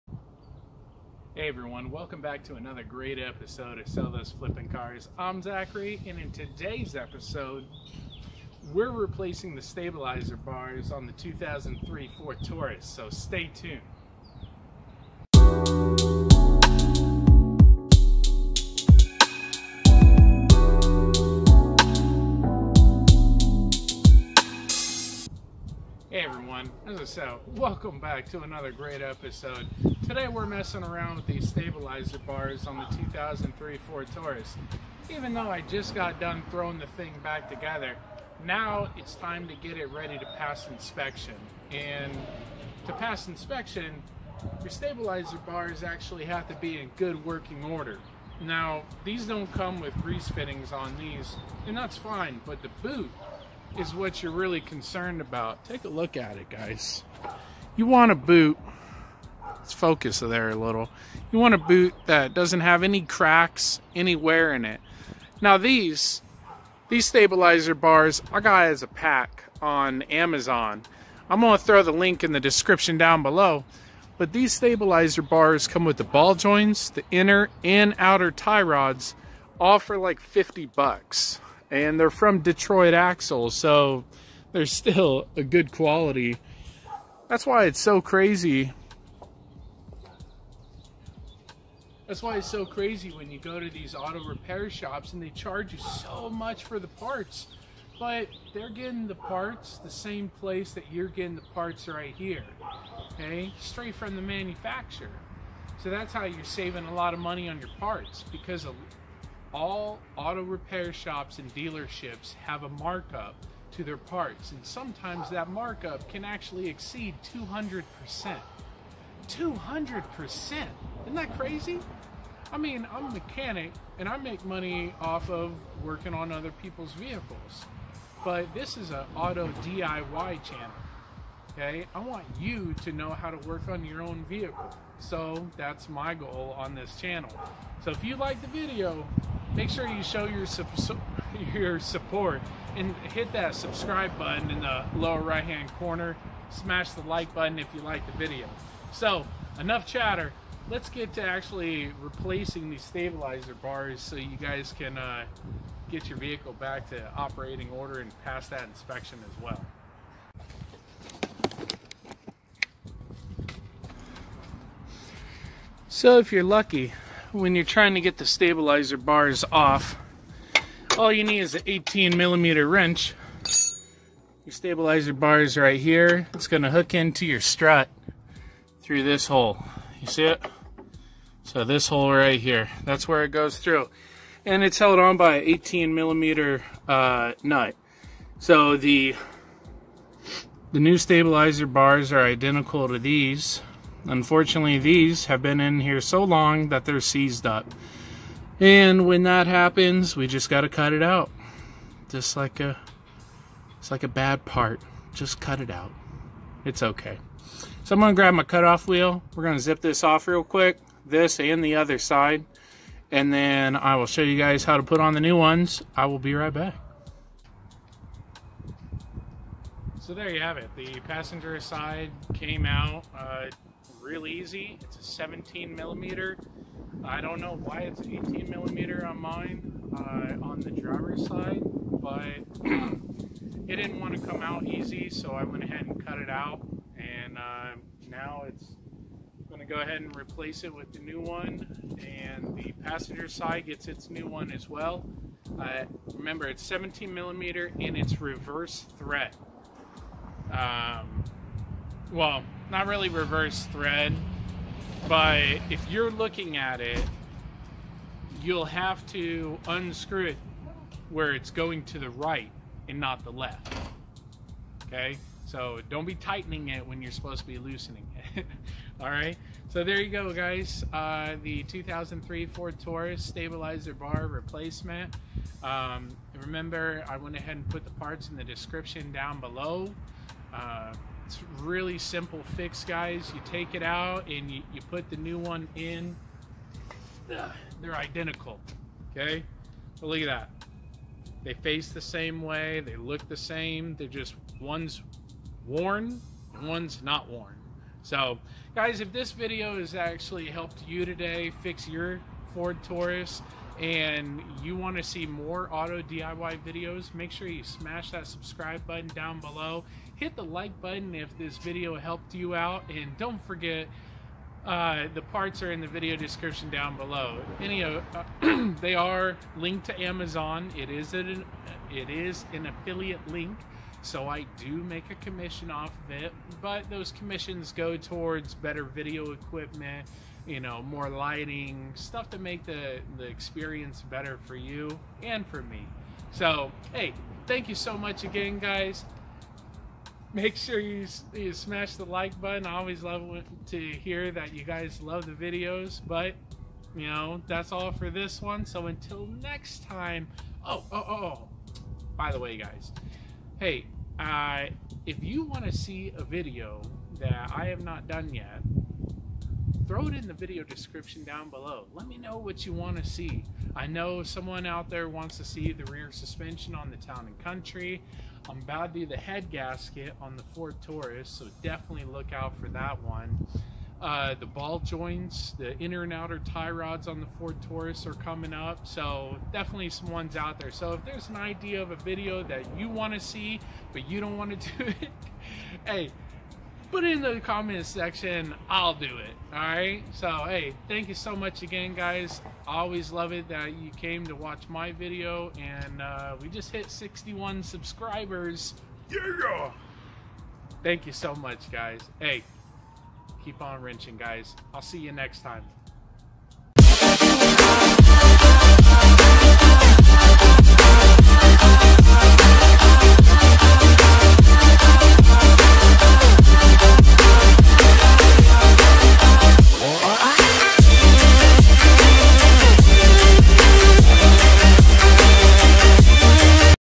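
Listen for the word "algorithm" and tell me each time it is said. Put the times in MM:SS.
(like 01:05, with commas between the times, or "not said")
not said.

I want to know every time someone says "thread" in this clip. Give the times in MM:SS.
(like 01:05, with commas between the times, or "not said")
04:08, 04:13.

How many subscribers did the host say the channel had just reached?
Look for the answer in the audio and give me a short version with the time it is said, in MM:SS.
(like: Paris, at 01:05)
61, at 06:36.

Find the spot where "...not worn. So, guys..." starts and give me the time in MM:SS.
04:57.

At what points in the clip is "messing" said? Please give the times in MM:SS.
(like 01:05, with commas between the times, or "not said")
00:30.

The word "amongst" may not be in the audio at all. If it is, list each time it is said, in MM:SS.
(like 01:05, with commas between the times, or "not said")
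not said.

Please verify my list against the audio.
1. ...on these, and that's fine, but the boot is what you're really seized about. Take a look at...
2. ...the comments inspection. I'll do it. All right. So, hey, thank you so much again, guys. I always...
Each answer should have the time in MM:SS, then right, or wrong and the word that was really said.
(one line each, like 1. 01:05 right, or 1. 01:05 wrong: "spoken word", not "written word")
1. 00:50 wrong: "concerned", not "seized"
2. 06:27 wrong: "section", not "inspection".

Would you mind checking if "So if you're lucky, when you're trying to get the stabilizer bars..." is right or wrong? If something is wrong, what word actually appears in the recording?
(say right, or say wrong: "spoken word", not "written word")
right.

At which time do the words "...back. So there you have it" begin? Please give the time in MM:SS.
03:36.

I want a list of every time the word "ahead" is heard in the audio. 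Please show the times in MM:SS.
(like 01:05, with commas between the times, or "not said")
03:55, 03:59, 04:37.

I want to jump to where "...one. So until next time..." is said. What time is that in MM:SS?
05:48.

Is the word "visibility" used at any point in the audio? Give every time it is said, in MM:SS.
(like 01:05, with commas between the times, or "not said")
not said.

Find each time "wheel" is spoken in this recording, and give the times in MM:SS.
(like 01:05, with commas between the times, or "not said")
03:28.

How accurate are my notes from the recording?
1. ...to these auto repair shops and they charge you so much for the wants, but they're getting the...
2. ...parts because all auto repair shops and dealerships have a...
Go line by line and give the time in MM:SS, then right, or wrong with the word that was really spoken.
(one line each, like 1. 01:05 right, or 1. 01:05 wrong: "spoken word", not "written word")
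1. 01:33 wrong: "parts", not "wants"
2. 01:47 right.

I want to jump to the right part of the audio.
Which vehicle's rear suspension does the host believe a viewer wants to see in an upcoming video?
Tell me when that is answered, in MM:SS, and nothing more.
06:06.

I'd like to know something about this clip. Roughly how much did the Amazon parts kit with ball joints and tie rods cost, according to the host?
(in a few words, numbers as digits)
$50.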